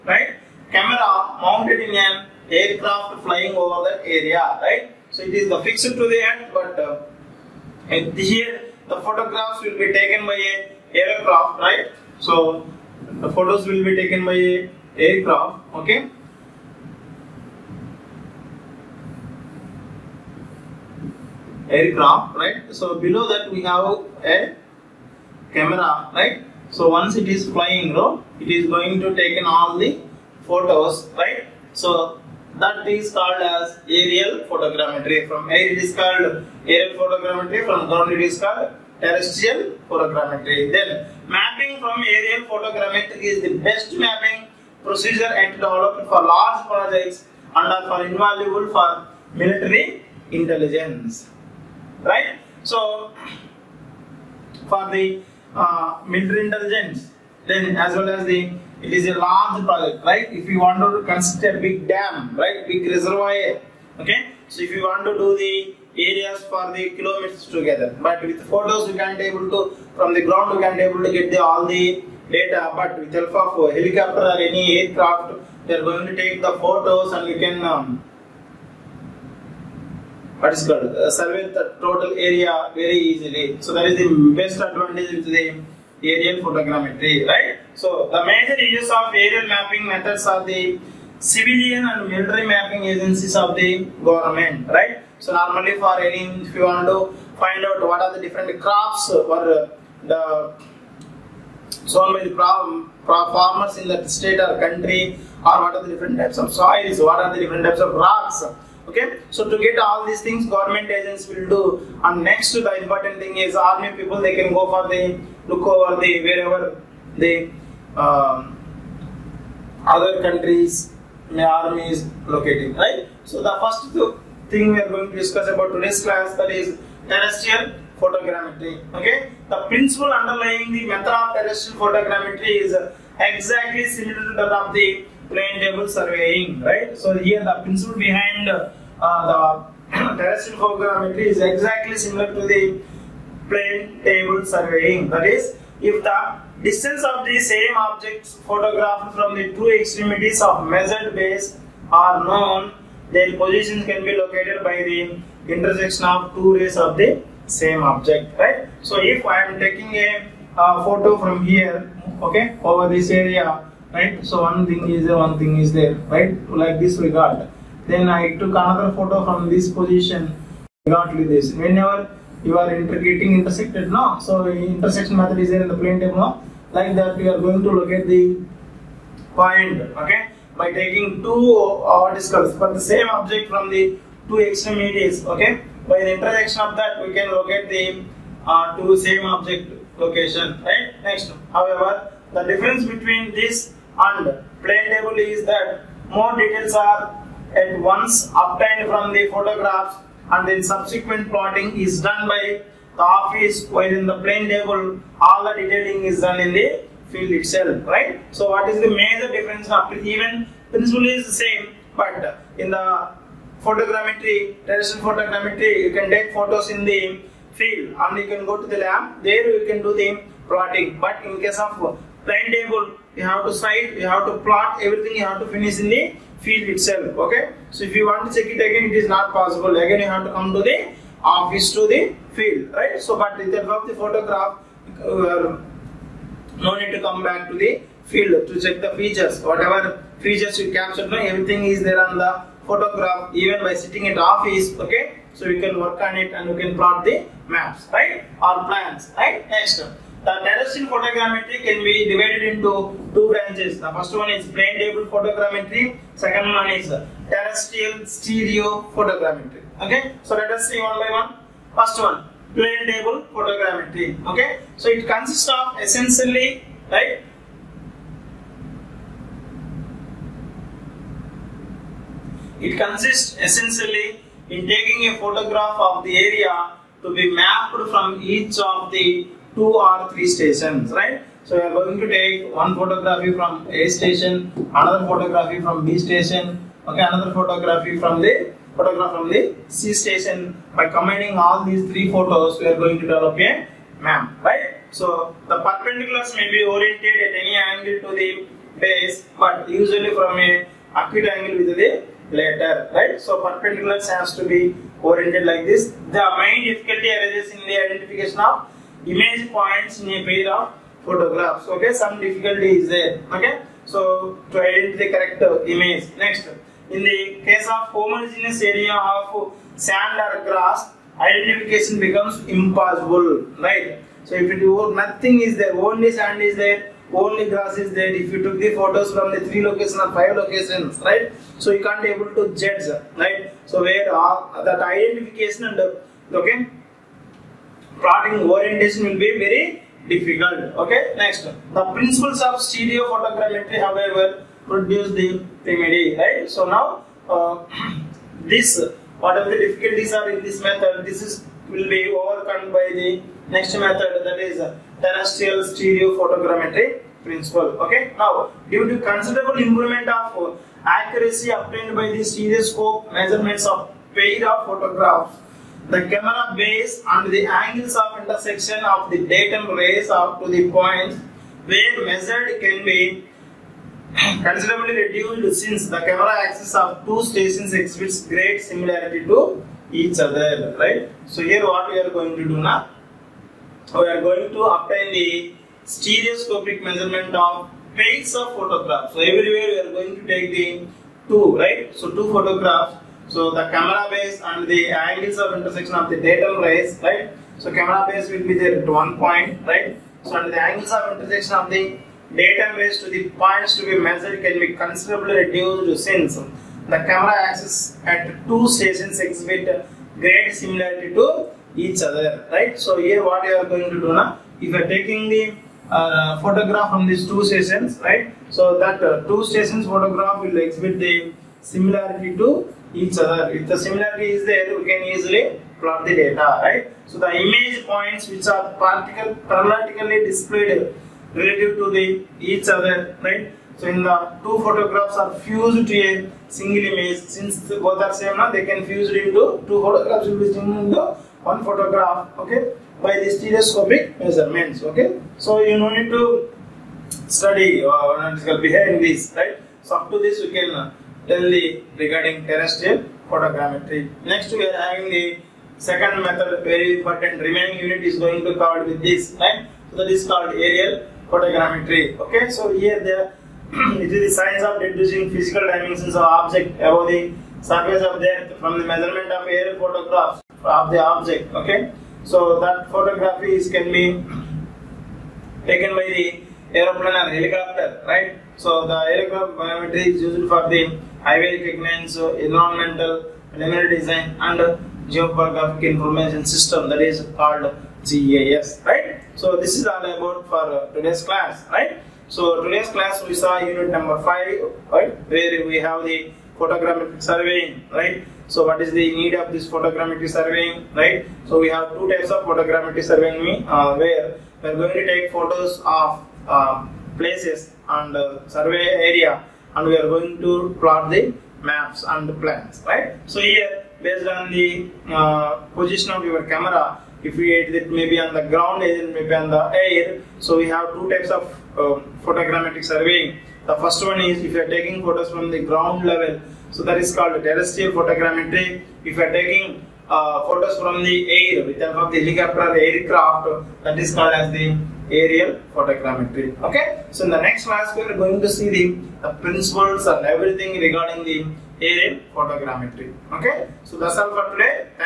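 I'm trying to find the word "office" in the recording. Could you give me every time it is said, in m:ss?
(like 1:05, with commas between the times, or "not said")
3:23, 3:51, 4:04.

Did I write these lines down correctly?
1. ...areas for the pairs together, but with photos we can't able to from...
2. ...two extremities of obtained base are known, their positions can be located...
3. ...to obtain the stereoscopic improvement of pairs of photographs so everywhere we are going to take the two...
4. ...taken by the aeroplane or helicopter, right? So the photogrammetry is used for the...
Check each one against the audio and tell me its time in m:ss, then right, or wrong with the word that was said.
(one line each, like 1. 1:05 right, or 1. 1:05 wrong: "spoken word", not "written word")
1. 1:05 wrong: "kilometers", not "pairs"
2. 2:29 wrong: "measured", not "obtained"
3. 6:24 wrong: "measurement", not "improvement"
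4. 7:55 right.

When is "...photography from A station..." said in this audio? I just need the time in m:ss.
4:42.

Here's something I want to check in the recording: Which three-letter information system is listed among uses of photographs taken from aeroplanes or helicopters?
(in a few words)
Geographic information system.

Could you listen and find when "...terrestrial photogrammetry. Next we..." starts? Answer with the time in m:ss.
7:32.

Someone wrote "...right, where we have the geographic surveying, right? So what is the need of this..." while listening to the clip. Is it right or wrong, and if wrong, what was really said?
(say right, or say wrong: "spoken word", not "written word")
wrong: "photogrammetric", not "geographic".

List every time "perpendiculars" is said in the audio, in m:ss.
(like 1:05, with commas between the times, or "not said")
4:55, 5:03.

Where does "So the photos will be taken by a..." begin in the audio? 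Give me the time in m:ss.
0:12.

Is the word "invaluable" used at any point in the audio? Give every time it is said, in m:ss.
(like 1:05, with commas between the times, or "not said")
0:48.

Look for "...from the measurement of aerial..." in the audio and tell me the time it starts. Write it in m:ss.
7:48.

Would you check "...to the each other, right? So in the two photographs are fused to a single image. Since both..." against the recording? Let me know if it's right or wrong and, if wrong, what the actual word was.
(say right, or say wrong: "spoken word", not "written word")
right.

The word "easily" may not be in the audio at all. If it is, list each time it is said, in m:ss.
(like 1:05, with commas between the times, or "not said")
1:23, 7:05.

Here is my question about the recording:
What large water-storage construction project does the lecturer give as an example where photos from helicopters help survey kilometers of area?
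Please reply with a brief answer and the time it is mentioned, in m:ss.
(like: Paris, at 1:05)
A big dam, at 1:01.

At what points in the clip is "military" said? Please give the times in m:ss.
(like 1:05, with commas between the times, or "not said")
0:49, 0:56, 1:32.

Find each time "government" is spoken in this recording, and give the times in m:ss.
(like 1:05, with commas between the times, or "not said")
1:34, 1:50.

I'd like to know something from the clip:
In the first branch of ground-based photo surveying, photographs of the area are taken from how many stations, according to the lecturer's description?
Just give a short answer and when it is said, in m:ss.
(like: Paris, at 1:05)
2 or 3, at 4:39.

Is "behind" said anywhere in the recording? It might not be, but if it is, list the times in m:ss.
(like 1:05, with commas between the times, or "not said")
2:17, 7:28.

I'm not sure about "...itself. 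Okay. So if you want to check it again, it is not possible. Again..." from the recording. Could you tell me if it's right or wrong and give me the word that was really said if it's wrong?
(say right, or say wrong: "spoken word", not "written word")
right.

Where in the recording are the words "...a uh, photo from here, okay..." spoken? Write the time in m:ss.
2:39.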